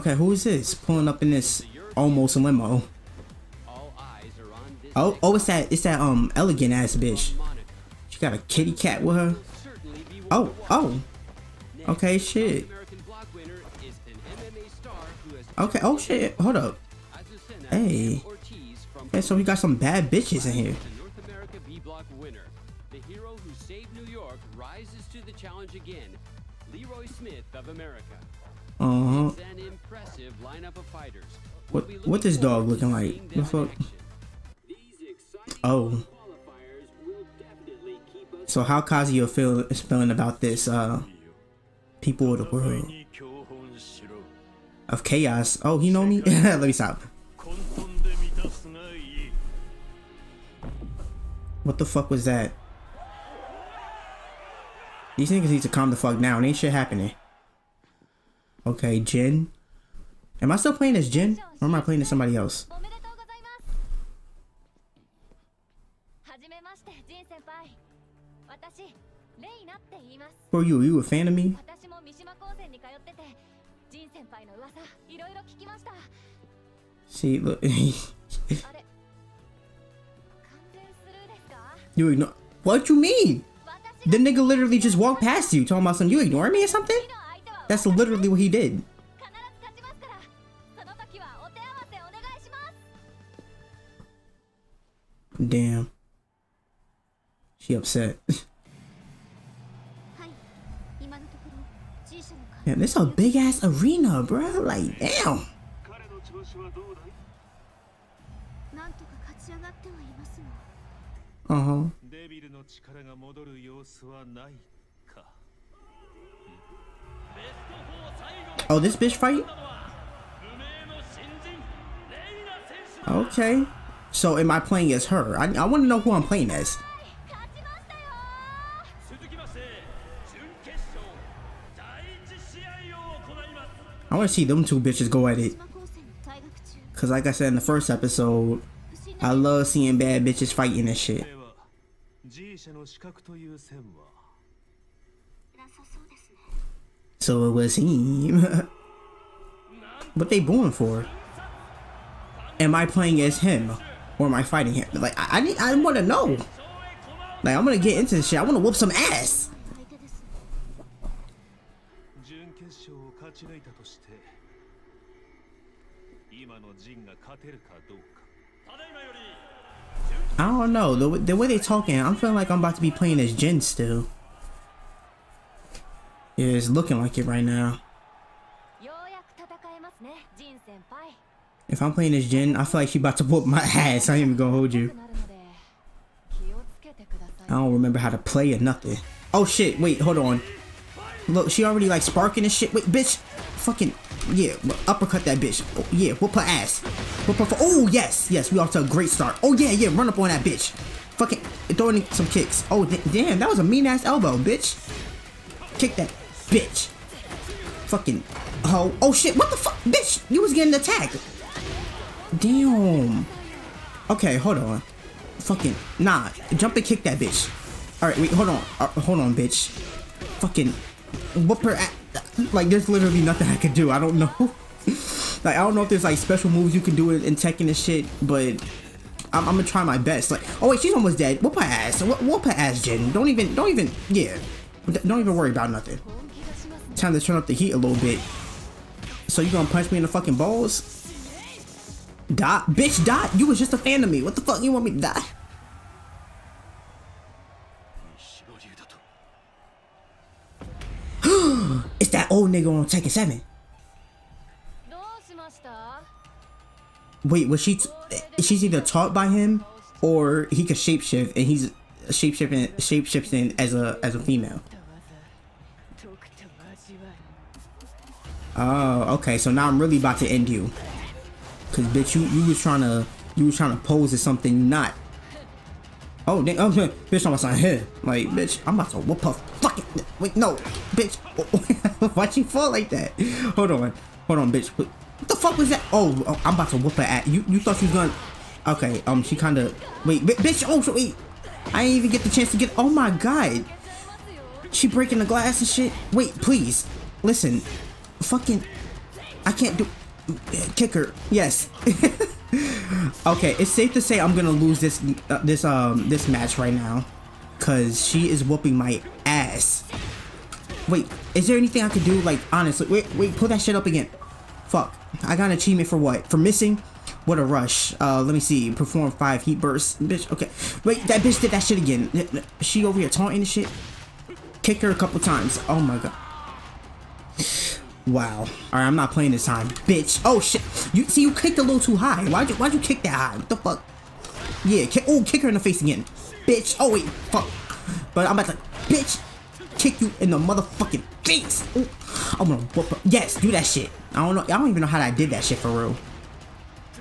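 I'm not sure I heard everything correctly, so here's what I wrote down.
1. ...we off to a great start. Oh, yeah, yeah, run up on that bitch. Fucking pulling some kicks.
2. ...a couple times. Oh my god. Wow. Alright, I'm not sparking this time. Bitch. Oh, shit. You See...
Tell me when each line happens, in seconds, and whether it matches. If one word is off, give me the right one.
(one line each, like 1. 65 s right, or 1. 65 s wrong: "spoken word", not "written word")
1. 198 s wrong: "throwing", not "pulling"
2. 324 s wrong: "playing", not "sparking".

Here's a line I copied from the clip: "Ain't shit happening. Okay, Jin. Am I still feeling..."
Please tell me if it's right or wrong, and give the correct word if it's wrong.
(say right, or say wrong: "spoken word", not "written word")
wrong: "playing", not "feeling".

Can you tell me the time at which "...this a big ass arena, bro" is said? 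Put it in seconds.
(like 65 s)
102 s.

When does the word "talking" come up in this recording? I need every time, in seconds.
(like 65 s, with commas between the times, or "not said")
85 s, 171 s.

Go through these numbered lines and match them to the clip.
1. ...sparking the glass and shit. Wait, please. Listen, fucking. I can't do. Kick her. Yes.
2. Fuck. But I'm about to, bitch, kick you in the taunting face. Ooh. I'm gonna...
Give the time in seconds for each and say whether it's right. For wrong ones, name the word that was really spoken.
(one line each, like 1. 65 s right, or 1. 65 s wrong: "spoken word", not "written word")
1. 294 s wrong: "breaking", not "sparking"
2. 337 s wrong: "motherfucking", not "taunting".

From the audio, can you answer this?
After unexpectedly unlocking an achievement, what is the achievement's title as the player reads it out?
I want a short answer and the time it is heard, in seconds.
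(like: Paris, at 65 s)
What a Rush, at 317 s.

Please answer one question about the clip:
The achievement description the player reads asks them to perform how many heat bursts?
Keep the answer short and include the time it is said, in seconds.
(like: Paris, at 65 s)
5, at 319 s.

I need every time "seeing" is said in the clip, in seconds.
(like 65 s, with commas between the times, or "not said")
139 s.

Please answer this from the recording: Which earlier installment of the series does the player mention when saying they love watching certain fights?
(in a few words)
first episode.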